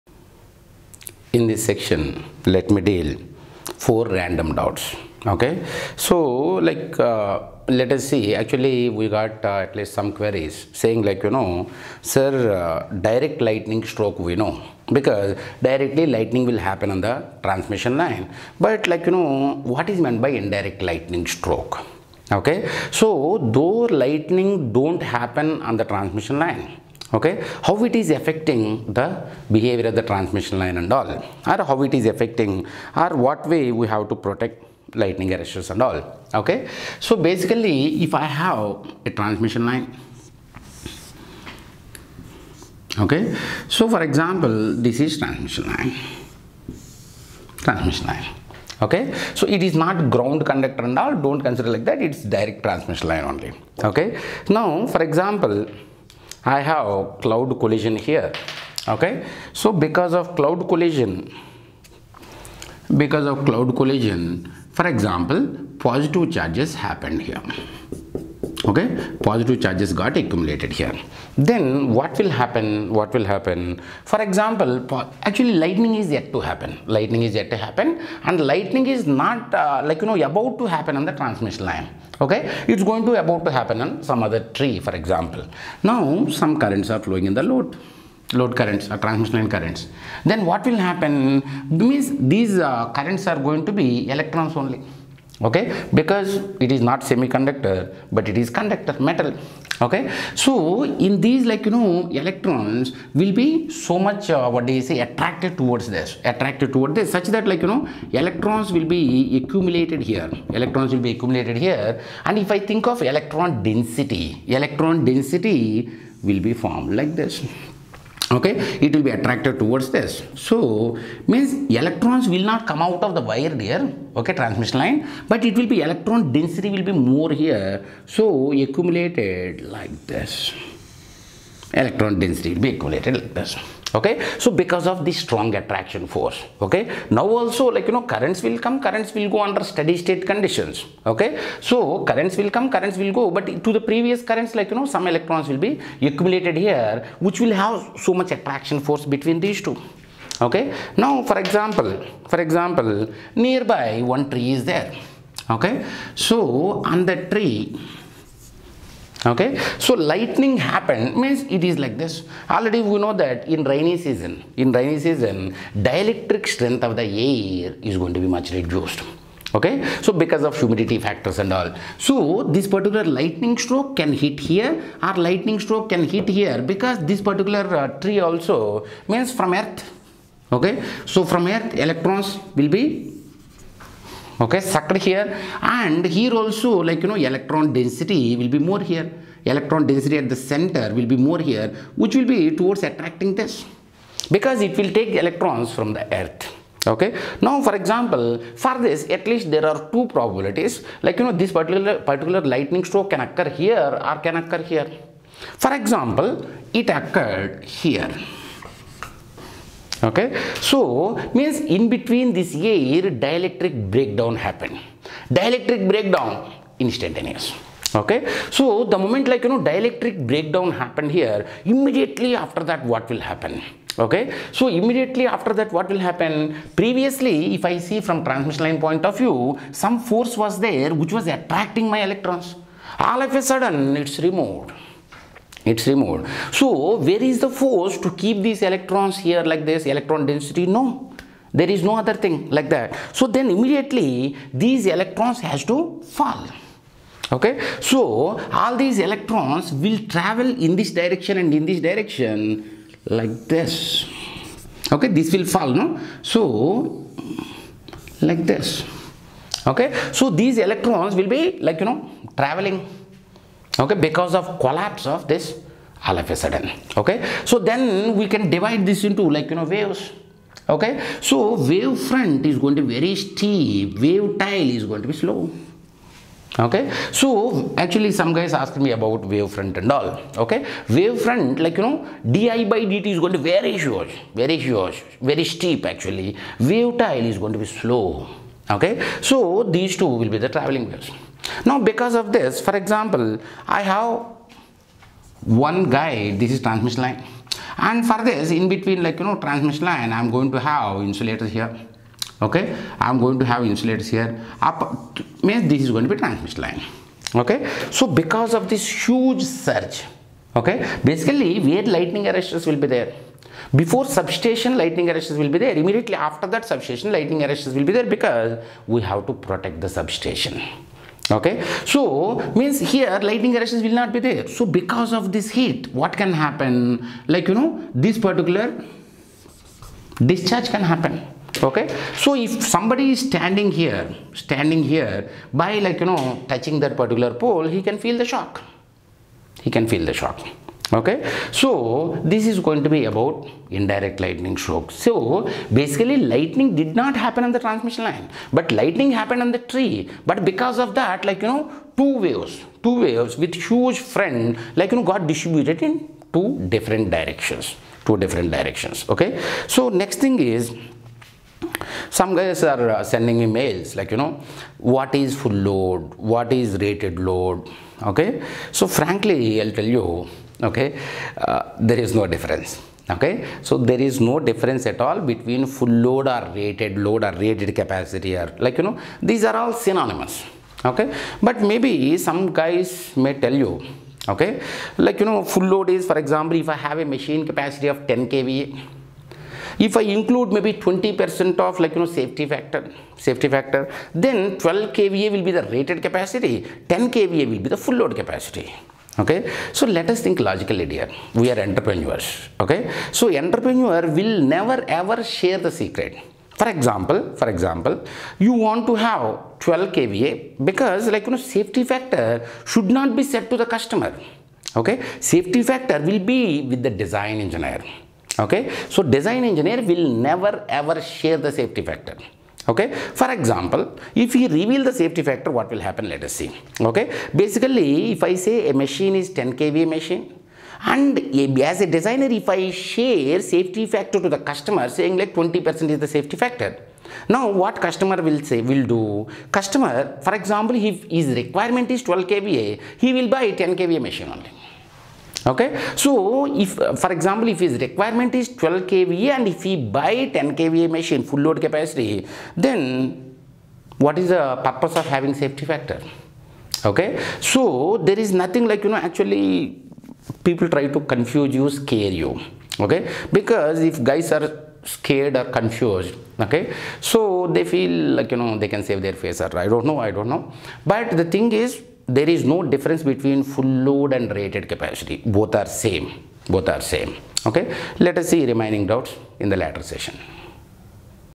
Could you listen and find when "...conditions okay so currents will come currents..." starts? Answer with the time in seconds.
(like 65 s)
140 s.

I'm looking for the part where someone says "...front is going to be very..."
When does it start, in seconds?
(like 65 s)
271 s.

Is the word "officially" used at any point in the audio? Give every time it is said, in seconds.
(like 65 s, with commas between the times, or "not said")
not said.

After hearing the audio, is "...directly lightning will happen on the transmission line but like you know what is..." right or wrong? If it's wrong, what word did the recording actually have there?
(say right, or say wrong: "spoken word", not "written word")
right.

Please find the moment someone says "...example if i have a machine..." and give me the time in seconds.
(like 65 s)
386 s.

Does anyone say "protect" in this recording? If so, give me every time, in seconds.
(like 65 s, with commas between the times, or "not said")
34 s, 319 s.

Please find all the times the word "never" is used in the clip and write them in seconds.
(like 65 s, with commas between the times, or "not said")
404 s, 420 s.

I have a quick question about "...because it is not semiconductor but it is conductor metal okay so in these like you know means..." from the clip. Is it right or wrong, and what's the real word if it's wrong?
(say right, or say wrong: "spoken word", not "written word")
wrong: "electrons", not "means".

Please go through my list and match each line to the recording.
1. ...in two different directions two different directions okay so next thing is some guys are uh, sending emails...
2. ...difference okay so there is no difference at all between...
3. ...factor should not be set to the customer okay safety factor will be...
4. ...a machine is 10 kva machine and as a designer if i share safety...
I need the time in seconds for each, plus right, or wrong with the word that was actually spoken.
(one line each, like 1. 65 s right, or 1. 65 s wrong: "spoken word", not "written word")
1. 355 s right
2. 372 s right
3. 411 s right
4. 428 s right.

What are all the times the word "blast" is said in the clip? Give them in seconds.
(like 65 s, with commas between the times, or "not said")
not said.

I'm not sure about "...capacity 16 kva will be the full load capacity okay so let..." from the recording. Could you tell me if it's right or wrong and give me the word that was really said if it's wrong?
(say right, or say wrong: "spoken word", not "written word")
wrong: "10", not "16".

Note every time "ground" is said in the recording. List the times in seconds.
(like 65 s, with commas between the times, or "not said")
50 s.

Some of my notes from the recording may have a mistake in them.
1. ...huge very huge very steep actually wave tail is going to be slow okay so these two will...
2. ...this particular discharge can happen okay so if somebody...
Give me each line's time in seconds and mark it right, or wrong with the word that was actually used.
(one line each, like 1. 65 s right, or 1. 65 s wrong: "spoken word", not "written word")
1. 283 s right
2. 327 s right.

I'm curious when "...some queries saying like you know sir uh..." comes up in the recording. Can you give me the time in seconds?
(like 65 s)
9 s.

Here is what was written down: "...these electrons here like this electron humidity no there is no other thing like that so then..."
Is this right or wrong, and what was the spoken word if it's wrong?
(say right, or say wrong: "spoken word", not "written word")
wrong: "density", not "humidity".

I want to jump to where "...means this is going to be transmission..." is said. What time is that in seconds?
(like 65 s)
305 s.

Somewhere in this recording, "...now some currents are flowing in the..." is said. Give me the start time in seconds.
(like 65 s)
85 s.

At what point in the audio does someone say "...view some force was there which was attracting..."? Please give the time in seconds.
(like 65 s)
229 s.